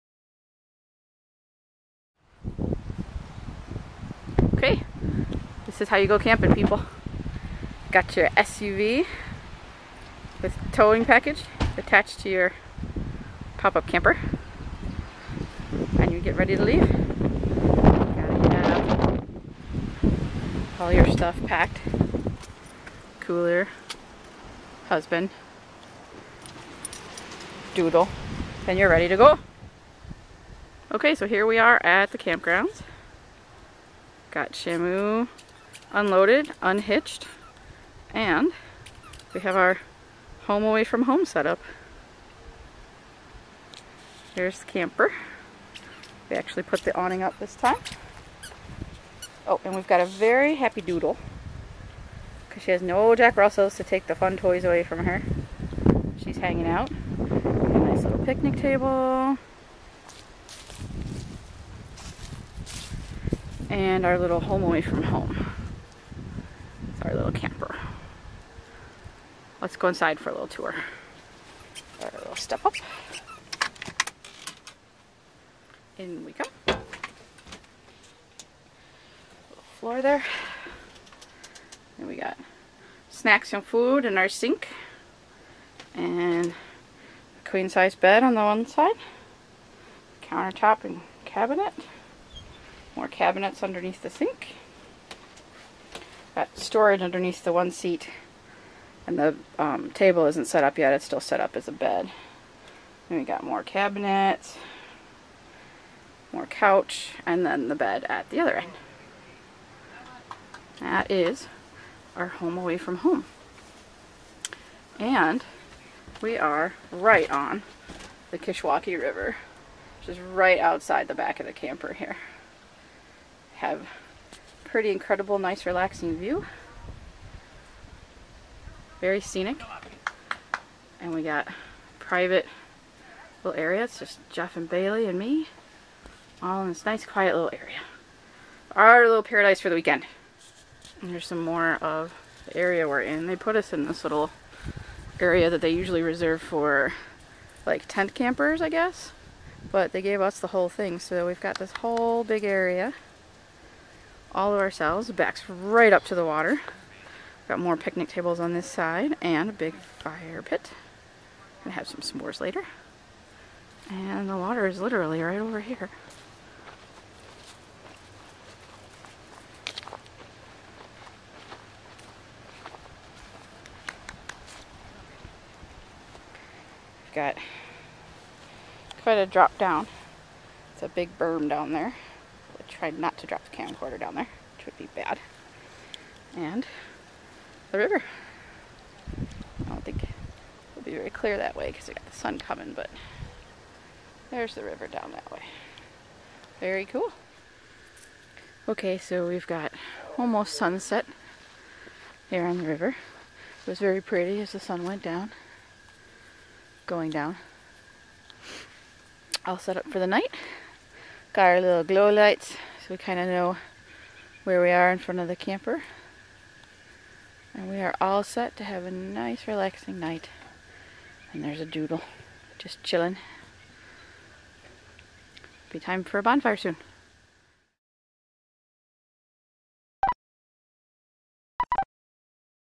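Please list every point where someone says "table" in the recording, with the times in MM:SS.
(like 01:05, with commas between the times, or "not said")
00:58, 01:39, 02:38.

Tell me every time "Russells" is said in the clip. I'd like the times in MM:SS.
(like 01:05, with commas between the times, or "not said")
00:53.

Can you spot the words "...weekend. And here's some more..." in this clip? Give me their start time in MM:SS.
02:19.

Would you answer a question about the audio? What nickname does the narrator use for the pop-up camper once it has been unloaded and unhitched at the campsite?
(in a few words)
Shamu.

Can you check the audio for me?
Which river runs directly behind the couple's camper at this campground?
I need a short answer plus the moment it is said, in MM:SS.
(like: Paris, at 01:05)
Kishwaukee River, at 01:58.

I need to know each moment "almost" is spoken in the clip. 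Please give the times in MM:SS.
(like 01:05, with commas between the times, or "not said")
03:20.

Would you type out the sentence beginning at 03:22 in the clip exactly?
It was very pretty as the sun went down, going down.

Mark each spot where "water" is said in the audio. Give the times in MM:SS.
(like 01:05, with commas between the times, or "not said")
02:36, 02:44.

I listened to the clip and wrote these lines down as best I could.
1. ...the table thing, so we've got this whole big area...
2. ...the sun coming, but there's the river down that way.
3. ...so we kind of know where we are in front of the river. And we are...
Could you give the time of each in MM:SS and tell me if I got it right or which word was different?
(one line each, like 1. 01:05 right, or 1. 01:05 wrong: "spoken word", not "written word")
1. 02:30 wrong: "whole", not "table"
2. 03:12 right
3. 03:32 wrong: "camper", not "river".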